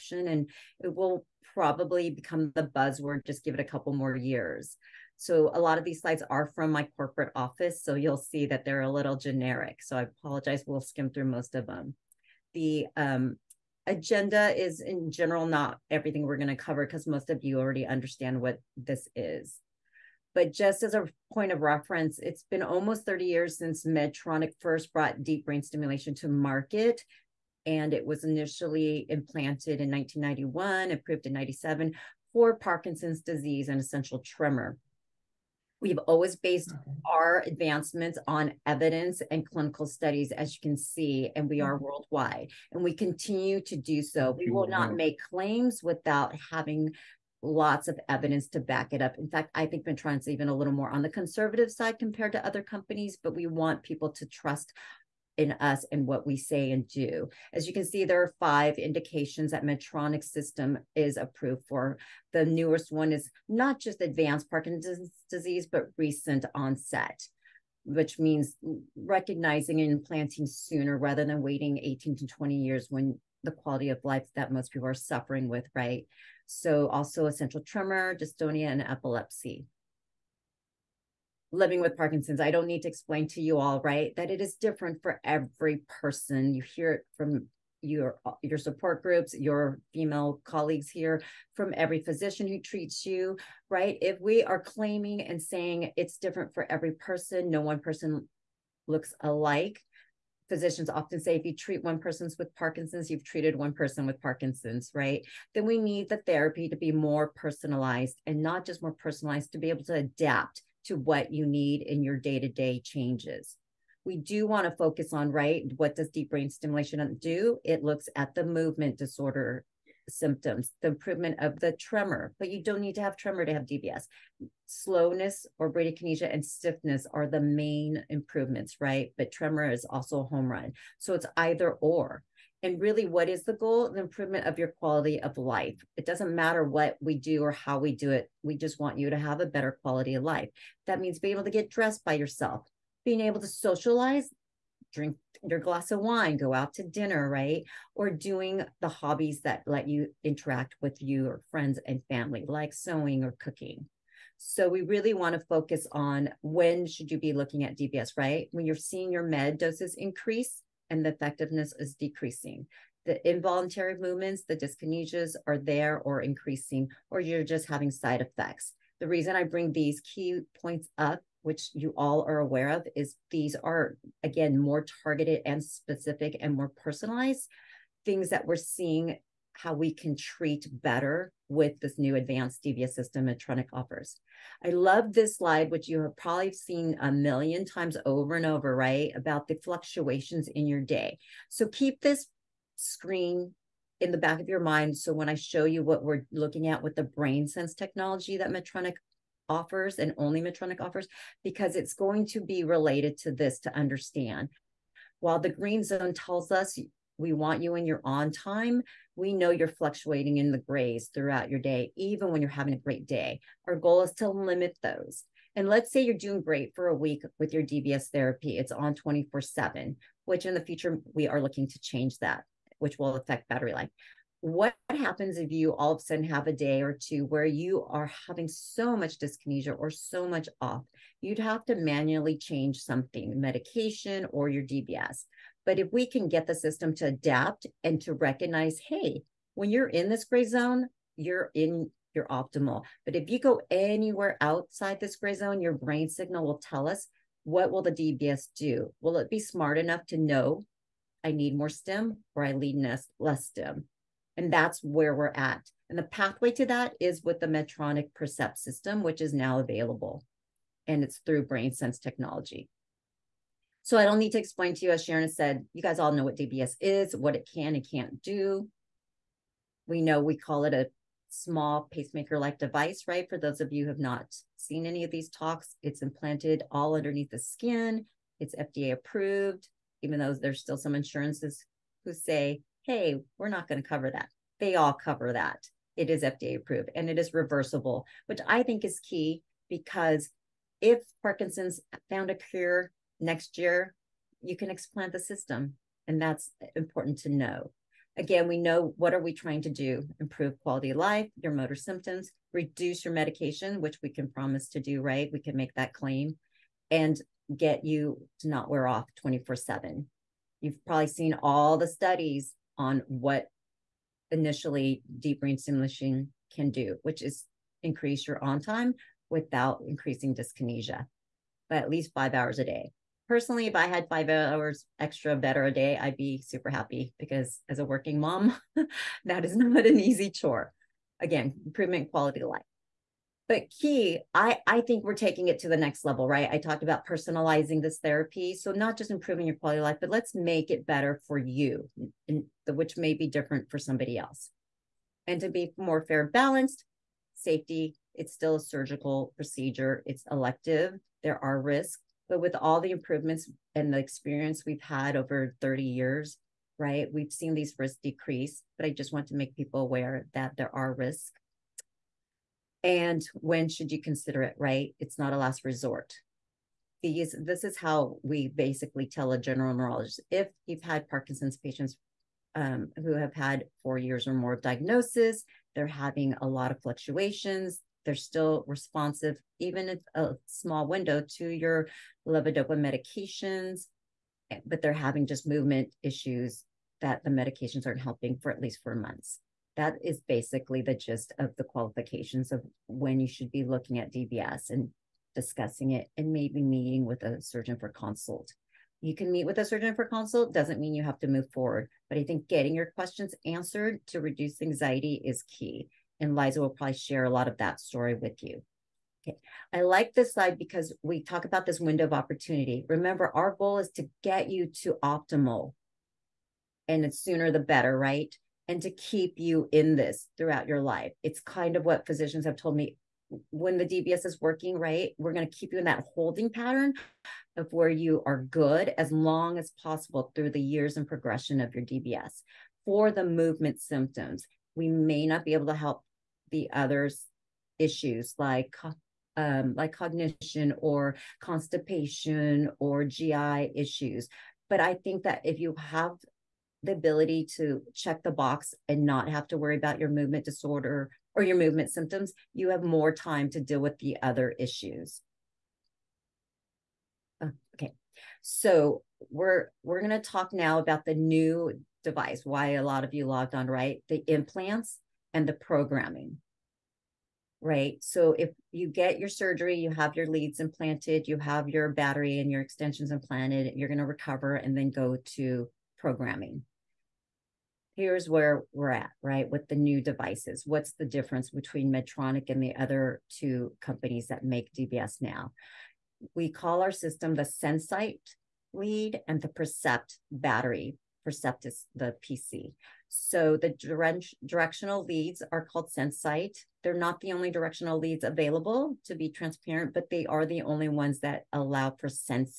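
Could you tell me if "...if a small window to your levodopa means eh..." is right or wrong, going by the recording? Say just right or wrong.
wrong.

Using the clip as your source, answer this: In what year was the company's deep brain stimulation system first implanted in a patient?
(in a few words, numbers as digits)
1991.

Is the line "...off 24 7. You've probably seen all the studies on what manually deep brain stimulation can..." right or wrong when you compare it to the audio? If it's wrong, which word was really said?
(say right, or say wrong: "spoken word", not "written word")
wrong: "initially", not "manually".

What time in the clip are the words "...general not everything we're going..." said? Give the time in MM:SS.
00:15.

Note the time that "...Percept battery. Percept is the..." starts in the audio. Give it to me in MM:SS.
08:09.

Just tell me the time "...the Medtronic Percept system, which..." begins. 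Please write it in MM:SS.
04:17.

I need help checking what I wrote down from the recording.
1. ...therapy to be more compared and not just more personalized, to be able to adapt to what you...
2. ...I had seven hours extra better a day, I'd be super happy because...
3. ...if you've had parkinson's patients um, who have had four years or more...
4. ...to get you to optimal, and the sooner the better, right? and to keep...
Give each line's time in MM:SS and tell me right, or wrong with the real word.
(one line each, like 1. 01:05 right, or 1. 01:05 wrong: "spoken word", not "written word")
1. 01:46 wrong: "personalized", not "compared"
2. 05:23 wrong: "five", not "seven"
3. 06:10 right
4. 06:53 right.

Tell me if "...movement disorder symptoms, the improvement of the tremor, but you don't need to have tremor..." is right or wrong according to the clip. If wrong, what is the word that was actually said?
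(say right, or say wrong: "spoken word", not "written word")
right.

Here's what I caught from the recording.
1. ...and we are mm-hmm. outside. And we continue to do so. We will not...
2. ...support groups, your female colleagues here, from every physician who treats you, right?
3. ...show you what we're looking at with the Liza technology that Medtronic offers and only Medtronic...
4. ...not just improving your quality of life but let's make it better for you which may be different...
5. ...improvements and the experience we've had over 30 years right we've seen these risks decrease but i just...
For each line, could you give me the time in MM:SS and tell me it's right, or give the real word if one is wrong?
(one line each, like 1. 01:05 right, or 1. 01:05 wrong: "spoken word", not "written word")
1. 00:41 wrong: "worldwide", not "outside"
2. 01:28 right
3. 03:15 wrong: "BrainSense", not "Liza"
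4. 05:38 right
5. 05:52 right.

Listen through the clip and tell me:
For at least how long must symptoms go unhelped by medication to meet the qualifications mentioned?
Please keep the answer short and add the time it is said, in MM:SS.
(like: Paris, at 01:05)
4 months, at 06:28.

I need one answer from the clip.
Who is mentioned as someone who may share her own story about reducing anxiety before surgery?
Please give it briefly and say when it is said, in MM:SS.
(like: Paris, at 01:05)
Liza, at 06:46.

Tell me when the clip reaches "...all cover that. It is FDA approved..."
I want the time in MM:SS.
04:44.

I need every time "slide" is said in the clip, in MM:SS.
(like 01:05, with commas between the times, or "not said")
00:05, 03:05, 06:50.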